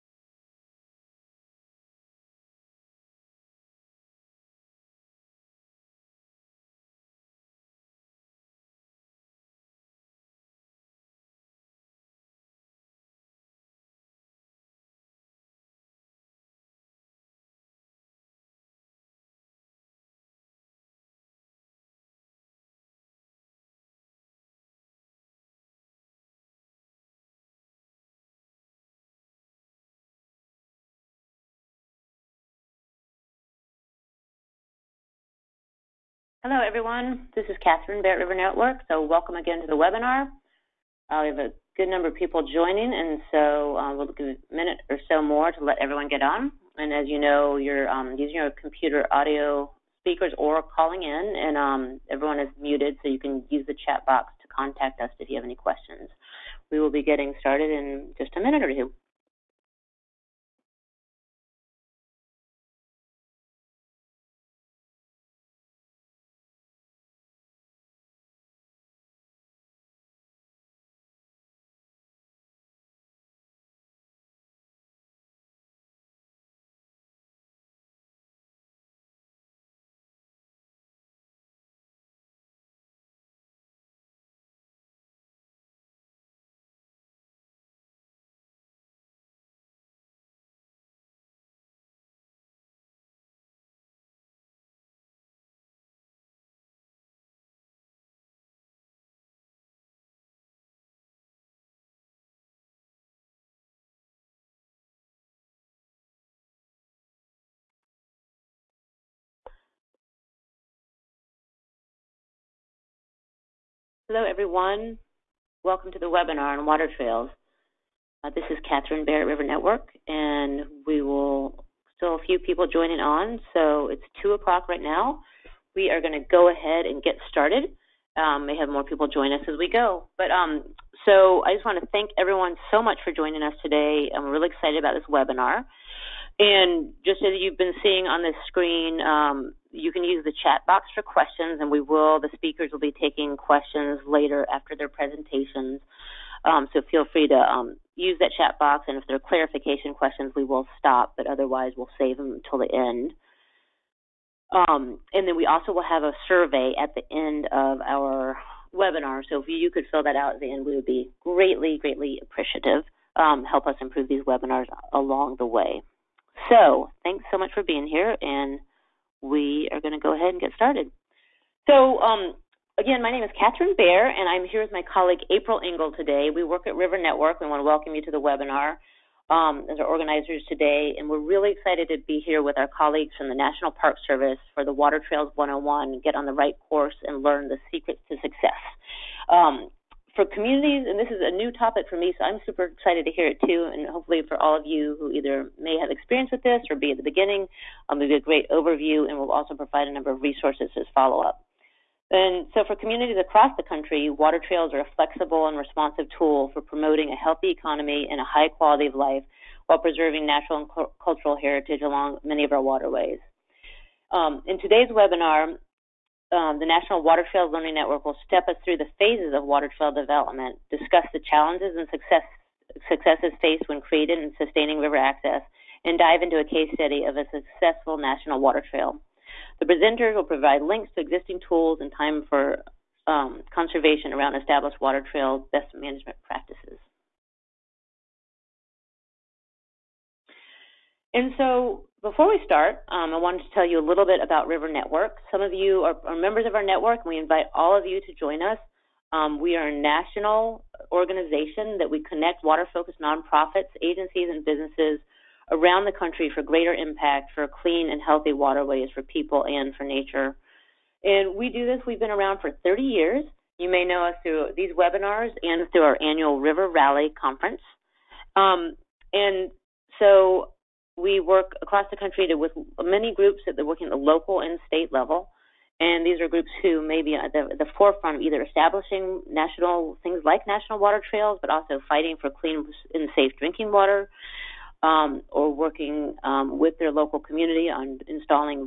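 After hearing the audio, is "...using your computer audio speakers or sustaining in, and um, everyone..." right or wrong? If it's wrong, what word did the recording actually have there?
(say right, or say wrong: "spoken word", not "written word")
wrong: "calling", not "sustaining".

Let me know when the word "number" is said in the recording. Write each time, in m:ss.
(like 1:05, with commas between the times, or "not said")
0:41, 3:19.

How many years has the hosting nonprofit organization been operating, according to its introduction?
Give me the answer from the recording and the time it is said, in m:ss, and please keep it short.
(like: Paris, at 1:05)
30, at 4:22.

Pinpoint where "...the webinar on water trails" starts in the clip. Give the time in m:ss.
1:55.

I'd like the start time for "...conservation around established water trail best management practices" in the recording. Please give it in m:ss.
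3:53.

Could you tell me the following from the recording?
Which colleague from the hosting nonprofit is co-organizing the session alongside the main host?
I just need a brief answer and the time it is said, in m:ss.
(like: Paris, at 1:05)
April Ingle, at 2:55.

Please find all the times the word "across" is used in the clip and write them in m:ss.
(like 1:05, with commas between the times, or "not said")
3:23, 4:31.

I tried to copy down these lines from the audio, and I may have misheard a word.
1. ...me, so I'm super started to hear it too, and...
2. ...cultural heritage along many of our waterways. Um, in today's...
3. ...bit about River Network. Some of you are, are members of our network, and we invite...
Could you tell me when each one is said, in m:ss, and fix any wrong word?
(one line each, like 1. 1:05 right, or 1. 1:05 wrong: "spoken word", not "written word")
1. 3:11 wrong: "excited", not "started"
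2. 3:31 right
3. 4:04 right.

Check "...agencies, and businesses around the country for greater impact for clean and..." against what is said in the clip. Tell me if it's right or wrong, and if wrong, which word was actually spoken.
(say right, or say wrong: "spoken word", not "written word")
right.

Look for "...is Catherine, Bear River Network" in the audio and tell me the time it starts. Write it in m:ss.
0:37.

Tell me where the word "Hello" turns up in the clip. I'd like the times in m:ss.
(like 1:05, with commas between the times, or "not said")
0:36, 1:54.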